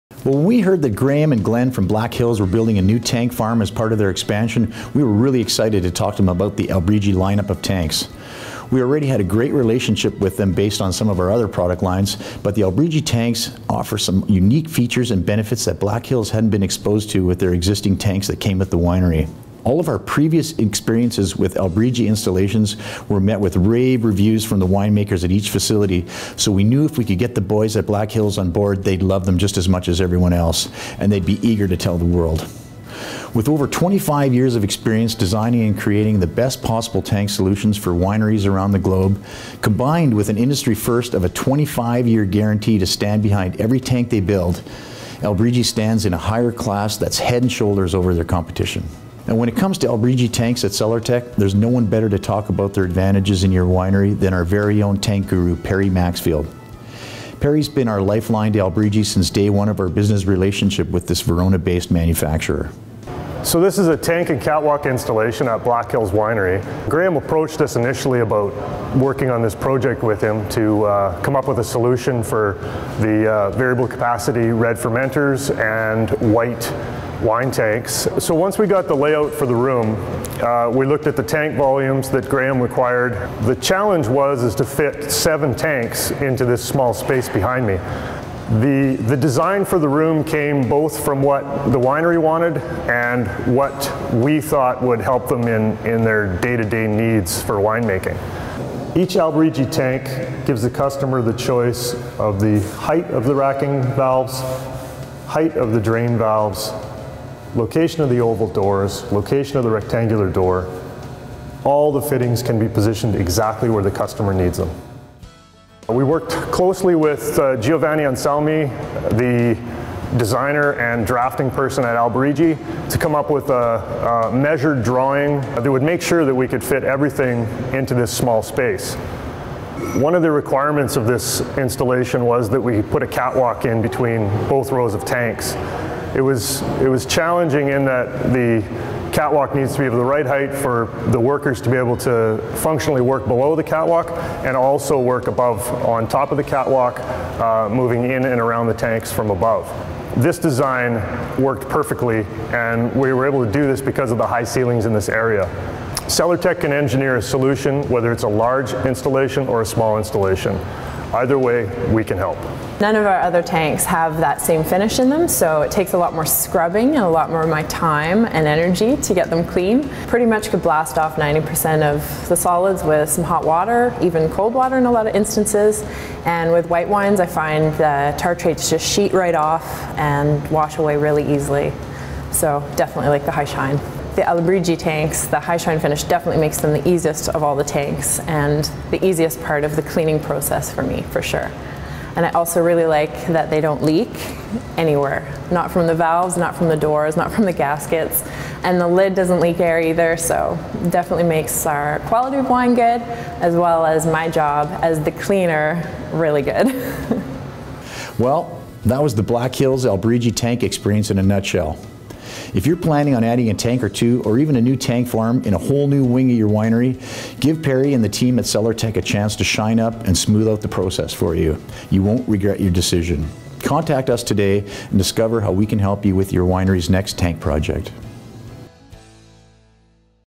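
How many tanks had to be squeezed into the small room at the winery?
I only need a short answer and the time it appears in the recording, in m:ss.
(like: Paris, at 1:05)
7, at 1:25.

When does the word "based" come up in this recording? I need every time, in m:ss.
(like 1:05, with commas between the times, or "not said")
0:10, 1:01.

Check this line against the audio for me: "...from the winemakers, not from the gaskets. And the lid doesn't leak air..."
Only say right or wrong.
wrong.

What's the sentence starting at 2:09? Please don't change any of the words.
One of the requirements of this installation was that we put a catwalk in between both rows of tanks.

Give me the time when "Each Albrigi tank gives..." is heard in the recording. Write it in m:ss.
1:38.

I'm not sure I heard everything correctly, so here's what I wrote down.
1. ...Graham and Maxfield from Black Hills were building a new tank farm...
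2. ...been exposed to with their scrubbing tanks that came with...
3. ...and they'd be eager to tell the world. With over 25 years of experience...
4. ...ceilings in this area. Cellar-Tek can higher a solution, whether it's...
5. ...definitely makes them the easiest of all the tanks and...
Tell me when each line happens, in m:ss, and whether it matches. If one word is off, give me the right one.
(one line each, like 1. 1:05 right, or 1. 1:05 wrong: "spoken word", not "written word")
1. 0:00 wrong: "Glenn", not "Maxfield"
2. 0:16 wrong: "existing", not "scrubbing"
3. 0:30 right
4. 2:34 wrong: "engineer", not "higher"
5. 3:06 right.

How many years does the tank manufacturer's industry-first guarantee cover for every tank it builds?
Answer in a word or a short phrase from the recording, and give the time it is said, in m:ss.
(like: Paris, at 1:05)
25, at 0:41.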